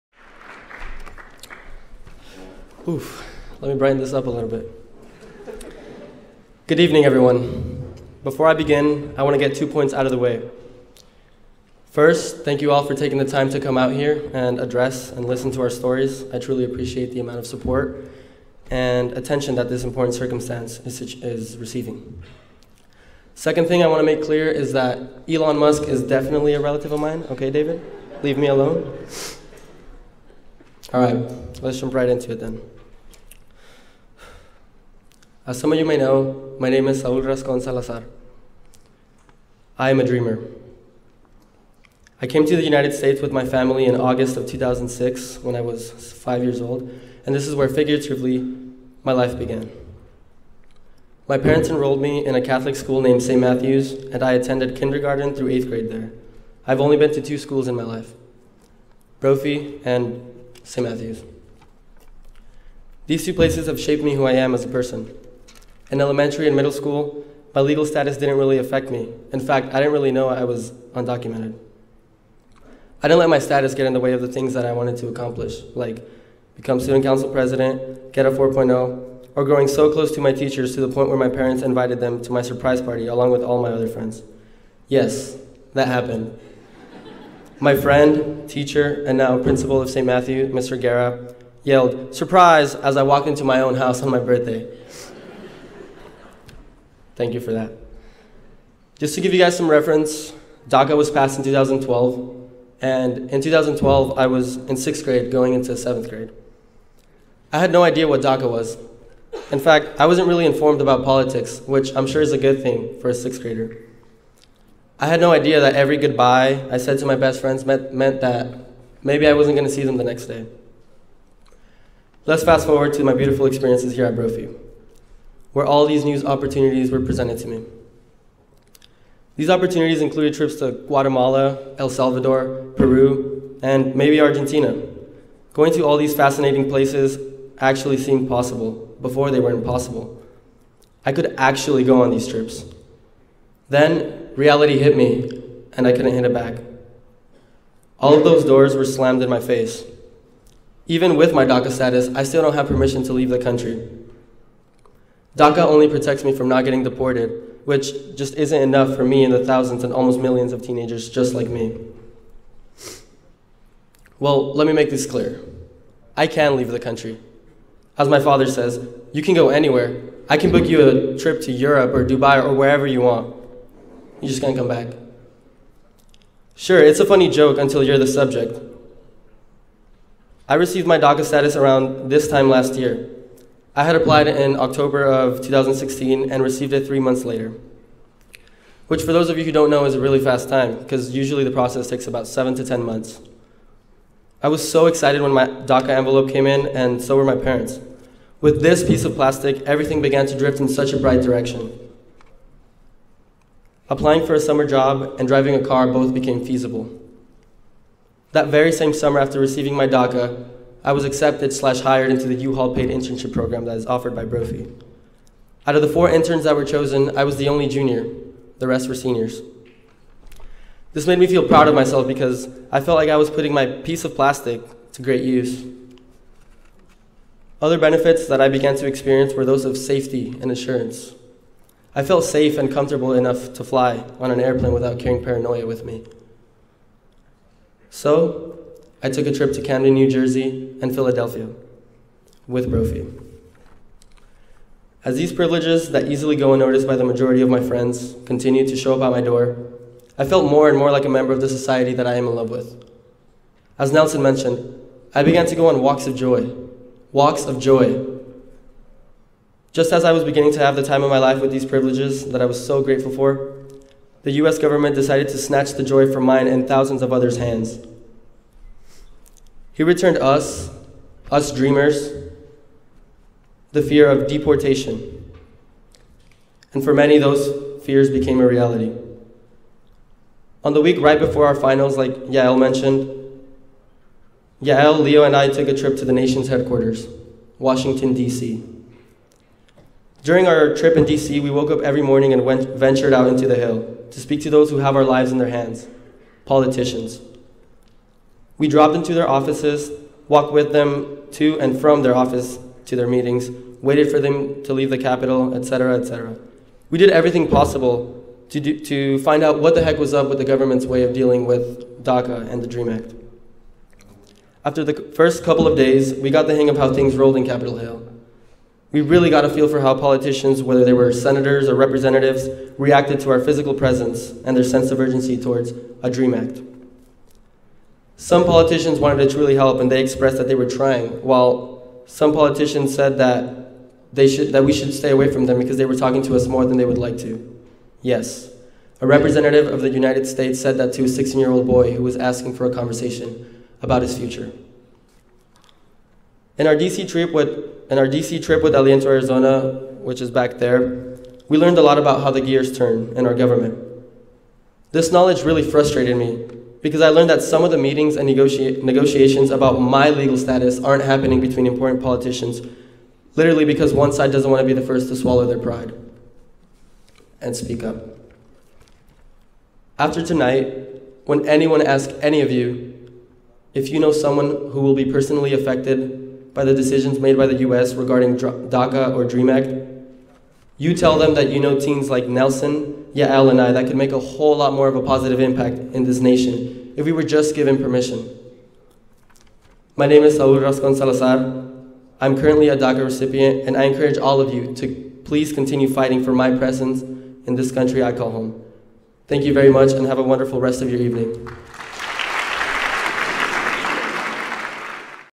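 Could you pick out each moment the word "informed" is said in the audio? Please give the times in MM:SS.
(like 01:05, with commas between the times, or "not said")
01:50.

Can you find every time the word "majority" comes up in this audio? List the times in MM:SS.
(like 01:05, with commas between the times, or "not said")
04:07.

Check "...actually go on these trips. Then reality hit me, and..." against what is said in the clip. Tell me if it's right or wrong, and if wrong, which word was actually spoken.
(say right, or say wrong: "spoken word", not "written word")
right.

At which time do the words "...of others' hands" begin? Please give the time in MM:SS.
04:27.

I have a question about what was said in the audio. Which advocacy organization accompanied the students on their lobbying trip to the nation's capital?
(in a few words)
Aliento Arizona.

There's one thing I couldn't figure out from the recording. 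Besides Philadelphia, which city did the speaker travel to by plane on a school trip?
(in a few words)
Camden, New Jersey.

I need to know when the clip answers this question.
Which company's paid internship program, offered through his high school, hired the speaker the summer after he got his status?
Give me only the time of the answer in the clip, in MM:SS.
03:32.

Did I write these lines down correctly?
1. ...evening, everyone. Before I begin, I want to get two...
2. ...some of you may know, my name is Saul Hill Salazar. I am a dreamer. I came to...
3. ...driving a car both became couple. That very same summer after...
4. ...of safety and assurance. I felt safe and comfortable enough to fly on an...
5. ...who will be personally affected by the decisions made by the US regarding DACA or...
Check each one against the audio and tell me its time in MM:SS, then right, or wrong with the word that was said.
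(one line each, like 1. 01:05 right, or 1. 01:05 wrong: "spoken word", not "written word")
1. 00:06 right
2. 00:35 wrong: "Rascon", not "Hill"
3. 03:25 wrong: "feasible", not "couple"
4. 03:49 right
5. 06:14 right.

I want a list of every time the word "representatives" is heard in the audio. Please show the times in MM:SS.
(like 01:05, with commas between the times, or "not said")
05:21, 05:39.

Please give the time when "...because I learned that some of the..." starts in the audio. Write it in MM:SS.
05:56.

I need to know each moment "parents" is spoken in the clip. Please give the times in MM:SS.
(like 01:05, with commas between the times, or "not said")
00:51, 01:21, 03:17.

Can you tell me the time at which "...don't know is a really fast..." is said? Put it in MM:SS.
03:09.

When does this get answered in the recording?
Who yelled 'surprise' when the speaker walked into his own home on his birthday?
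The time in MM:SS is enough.
01:30.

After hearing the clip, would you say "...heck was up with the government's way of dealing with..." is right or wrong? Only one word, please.
right.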